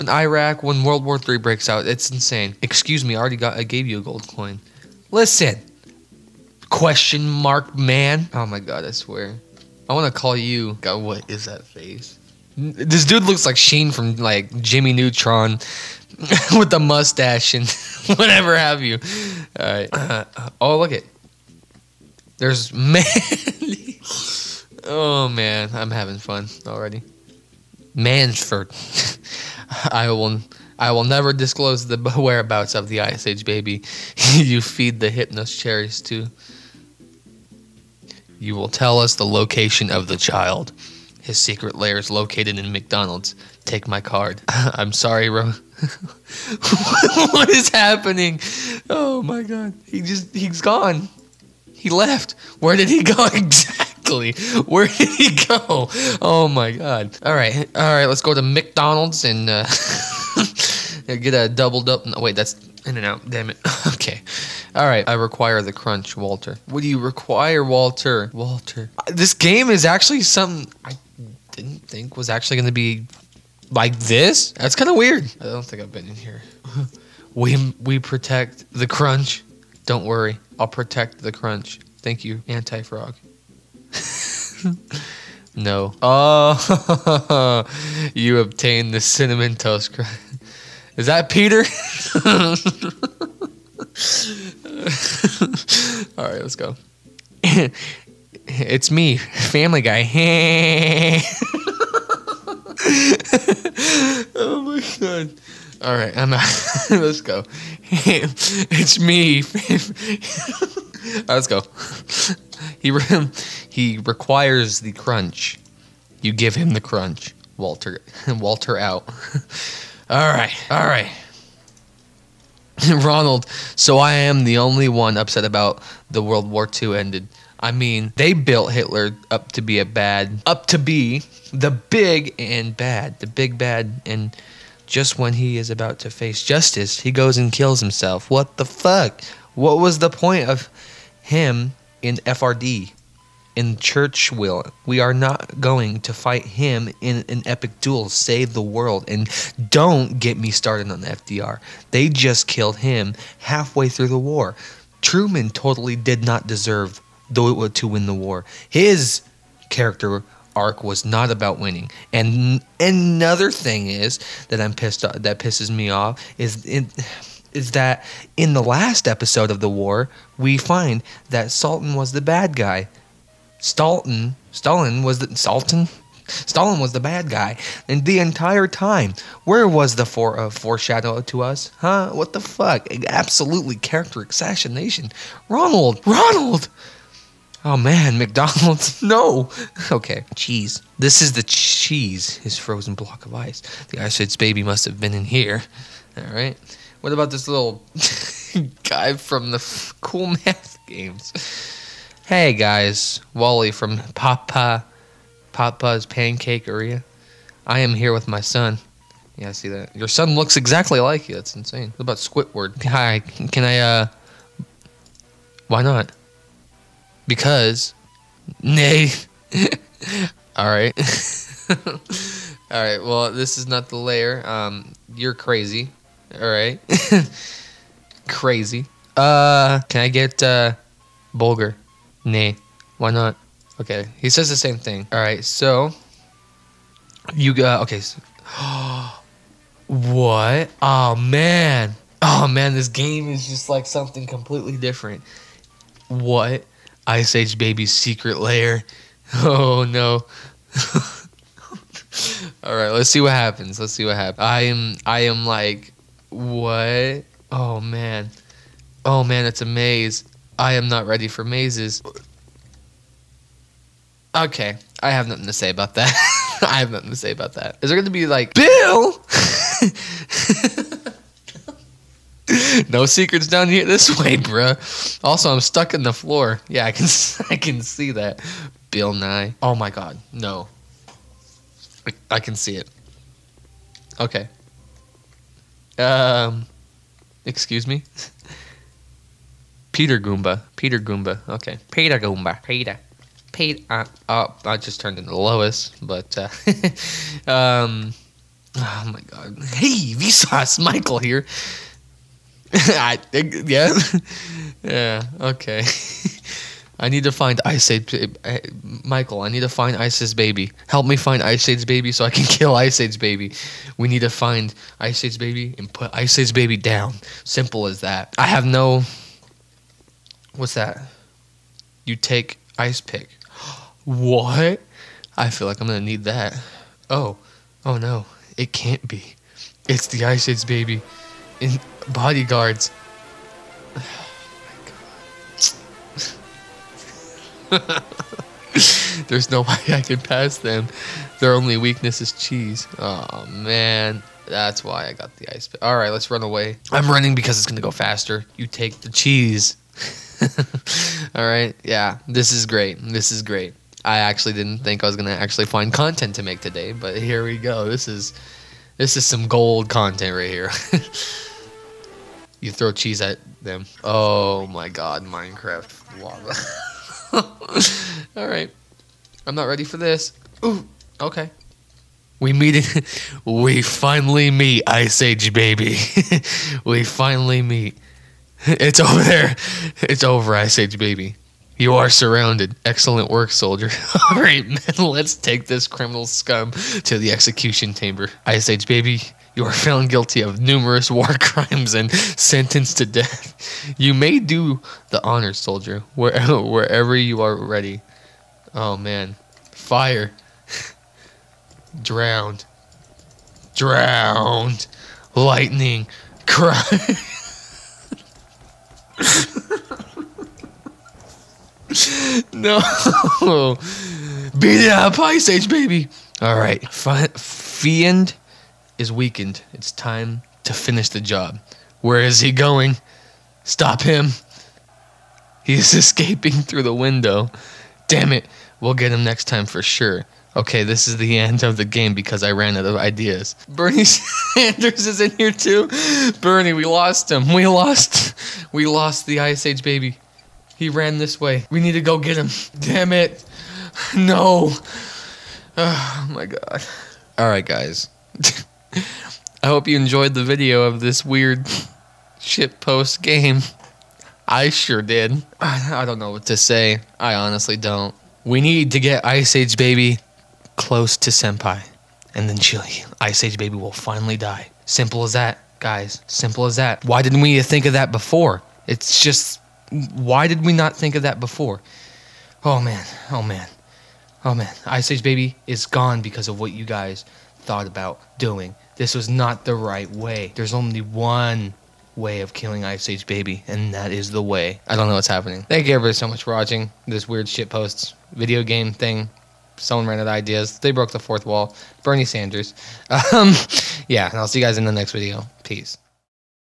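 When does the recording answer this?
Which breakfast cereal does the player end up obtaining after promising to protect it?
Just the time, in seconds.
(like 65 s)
89 s.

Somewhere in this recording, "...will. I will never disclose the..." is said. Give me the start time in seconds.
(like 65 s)
30 s.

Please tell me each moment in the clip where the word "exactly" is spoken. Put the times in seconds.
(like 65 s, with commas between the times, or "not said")
53 s, 210 s.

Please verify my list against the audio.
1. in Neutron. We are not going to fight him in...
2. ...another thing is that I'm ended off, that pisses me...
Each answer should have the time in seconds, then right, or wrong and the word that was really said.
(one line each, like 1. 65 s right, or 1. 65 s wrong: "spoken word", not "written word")
1. 143 s wrong: "Churchill", not "Neutron"
2. 162 s wrong: "pissed", not "ended".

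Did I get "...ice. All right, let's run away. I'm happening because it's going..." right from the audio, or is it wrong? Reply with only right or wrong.
wrong.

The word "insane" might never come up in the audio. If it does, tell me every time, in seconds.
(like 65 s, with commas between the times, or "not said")
2 s, 211 s.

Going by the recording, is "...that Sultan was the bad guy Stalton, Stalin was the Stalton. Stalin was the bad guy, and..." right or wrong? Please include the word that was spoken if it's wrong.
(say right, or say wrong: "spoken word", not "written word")
right.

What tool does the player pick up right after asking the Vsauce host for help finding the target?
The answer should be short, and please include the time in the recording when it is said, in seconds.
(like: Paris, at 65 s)
Ice pick, at 322 s.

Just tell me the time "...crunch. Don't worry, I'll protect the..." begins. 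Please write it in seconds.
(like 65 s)
78 s.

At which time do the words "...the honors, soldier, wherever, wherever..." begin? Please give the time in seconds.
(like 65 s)
395 s.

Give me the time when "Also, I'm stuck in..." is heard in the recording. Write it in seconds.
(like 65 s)
275 s.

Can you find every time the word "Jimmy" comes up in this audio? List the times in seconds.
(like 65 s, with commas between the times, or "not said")
14 s.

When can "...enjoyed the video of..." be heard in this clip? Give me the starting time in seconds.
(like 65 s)
449 s.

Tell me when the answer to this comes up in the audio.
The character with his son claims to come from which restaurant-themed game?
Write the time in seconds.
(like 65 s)
204 s.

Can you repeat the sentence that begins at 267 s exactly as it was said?
Is there going to be like Bill?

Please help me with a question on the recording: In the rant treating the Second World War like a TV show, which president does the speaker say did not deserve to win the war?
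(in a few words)
Truman.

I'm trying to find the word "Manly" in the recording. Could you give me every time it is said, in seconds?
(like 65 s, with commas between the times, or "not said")
22 s.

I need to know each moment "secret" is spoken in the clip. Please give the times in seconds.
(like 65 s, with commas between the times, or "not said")
41 s, 247 s, 273 s.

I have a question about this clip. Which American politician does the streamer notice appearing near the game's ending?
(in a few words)
Bernie Sanders.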